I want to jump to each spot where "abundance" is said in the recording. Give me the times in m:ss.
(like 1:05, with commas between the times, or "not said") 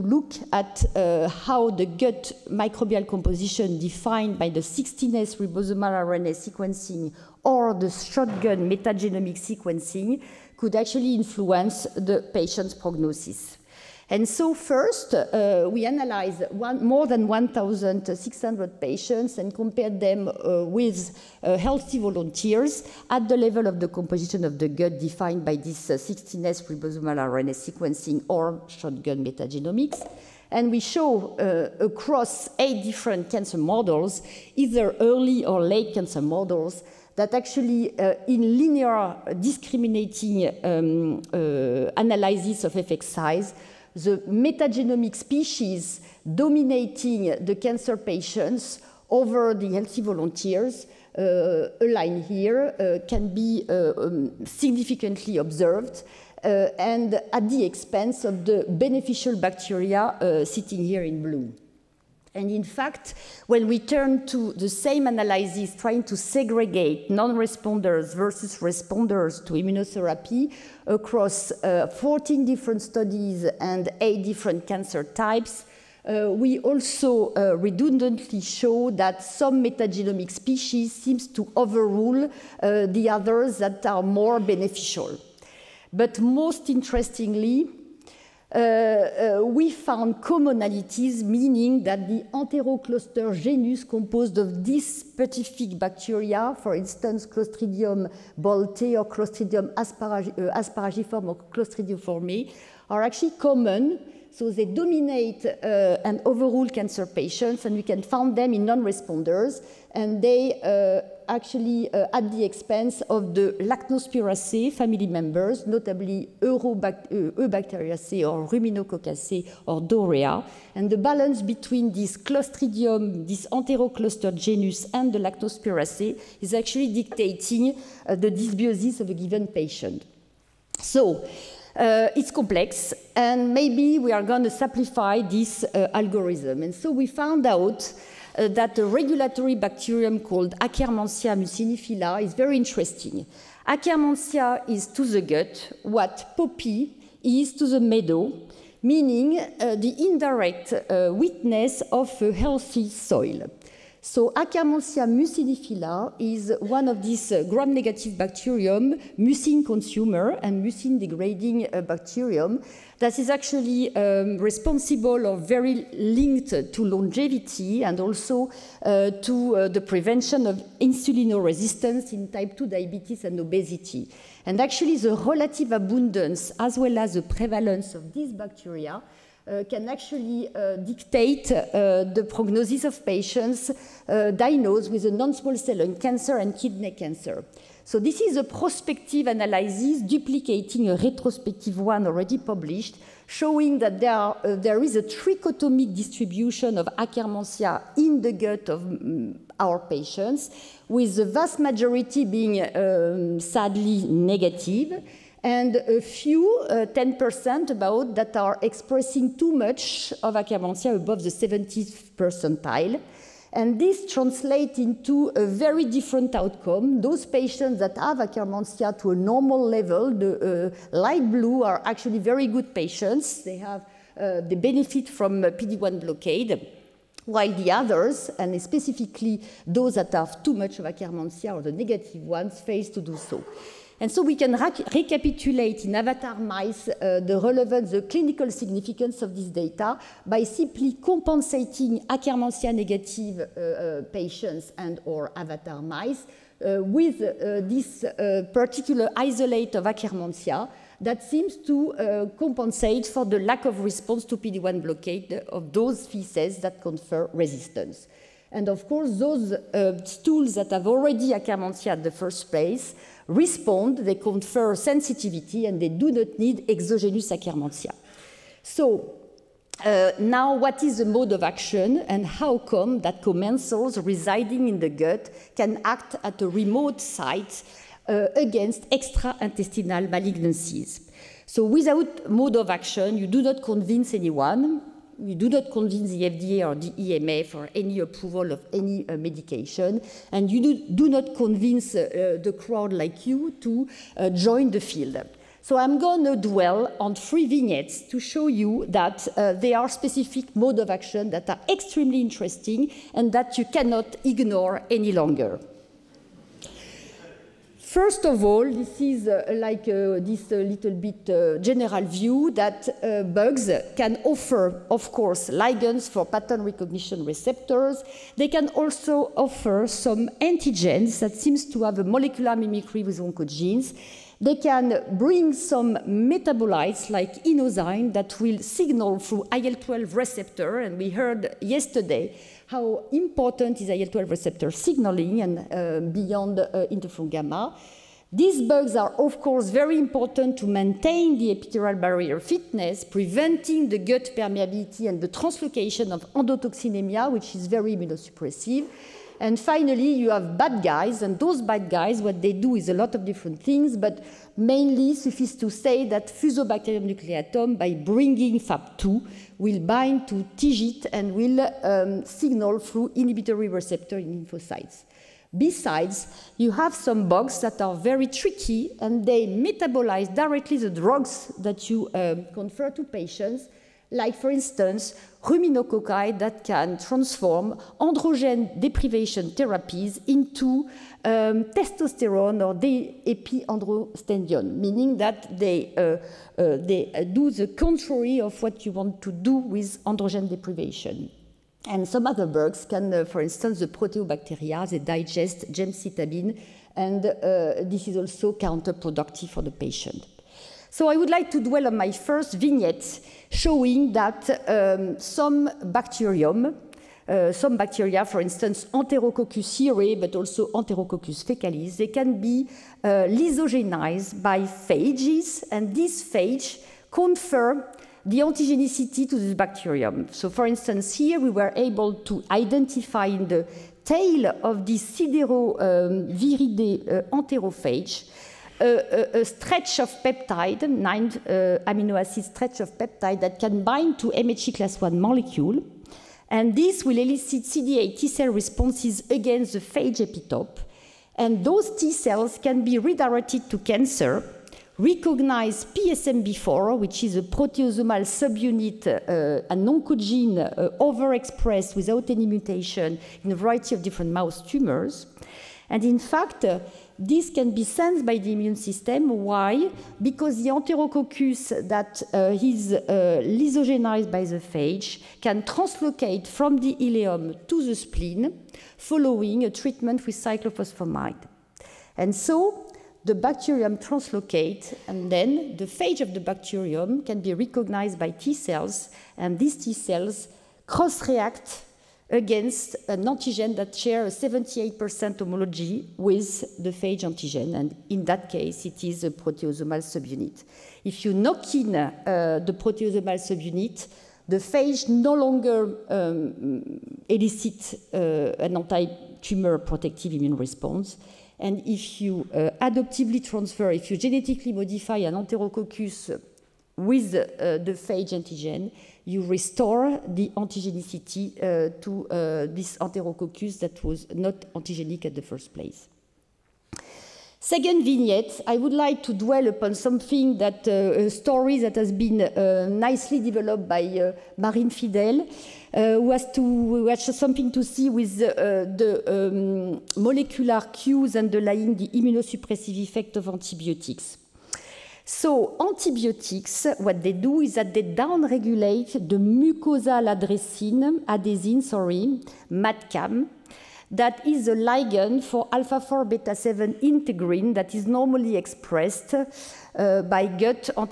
2:55.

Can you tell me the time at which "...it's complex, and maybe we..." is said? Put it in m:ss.
2:12.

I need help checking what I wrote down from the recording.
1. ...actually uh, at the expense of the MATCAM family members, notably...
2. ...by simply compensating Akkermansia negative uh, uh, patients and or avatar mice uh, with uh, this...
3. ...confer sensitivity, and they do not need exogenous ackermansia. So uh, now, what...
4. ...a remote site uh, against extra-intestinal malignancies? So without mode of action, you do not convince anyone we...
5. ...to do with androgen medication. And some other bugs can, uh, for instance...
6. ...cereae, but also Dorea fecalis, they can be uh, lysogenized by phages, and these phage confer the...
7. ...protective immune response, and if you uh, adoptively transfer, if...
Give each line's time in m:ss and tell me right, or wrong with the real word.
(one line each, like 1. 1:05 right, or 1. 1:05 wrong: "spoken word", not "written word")
1. 1:51 wrong: "Lactospiraceae", not "MATCAM"
2. 4:00 right
3. 4:24 right
4. 4:36 right
5. 6:29 wrong: "deprivation", not "medication"
6. 6:49 wrong: "Enterococcus", not "Dorea"
7. 8:19 right.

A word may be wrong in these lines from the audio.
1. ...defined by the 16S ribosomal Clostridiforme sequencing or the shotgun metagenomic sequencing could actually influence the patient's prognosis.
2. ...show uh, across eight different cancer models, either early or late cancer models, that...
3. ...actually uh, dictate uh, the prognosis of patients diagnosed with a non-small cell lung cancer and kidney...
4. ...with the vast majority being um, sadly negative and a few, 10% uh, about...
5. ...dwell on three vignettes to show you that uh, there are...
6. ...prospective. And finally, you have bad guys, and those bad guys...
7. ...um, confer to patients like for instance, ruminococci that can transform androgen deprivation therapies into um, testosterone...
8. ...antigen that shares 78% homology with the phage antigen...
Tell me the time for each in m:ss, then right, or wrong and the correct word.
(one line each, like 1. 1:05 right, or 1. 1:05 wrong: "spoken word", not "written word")
1. 0:03 wrong: "RNA", not "Clostridiforme"
2. 0:30 right
3. 2:59 right
4. 3:20 right
5. 4:56 right
6. 5:47 wrong: "immunosuppressive", not "prospective"
7. 6:12 right
8. 8:03 right.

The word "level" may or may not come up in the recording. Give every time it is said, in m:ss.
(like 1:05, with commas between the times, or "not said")
0:23, 3:39.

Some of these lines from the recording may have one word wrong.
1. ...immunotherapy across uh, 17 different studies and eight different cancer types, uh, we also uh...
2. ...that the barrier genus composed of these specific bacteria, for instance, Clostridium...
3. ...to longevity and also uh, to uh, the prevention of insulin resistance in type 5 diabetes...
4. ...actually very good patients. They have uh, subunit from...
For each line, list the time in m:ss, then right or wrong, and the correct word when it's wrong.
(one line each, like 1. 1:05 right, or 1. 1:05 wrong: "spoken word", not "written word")
1. 1:09 wrong: "14", not "17"
2. 1:31 wrong: "enterocluster", not "barrier"
3. 2:46 wrong: "2", not "5"
4. 3:41 wrong: "benefit", not "subunit".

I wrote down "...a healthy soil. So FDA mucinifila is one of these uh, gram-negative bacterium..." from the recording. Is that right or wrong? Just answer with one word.
wrong.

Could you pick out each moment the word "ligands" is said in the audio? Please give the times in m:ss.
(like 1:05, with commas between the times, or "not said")
5:15, 9:04.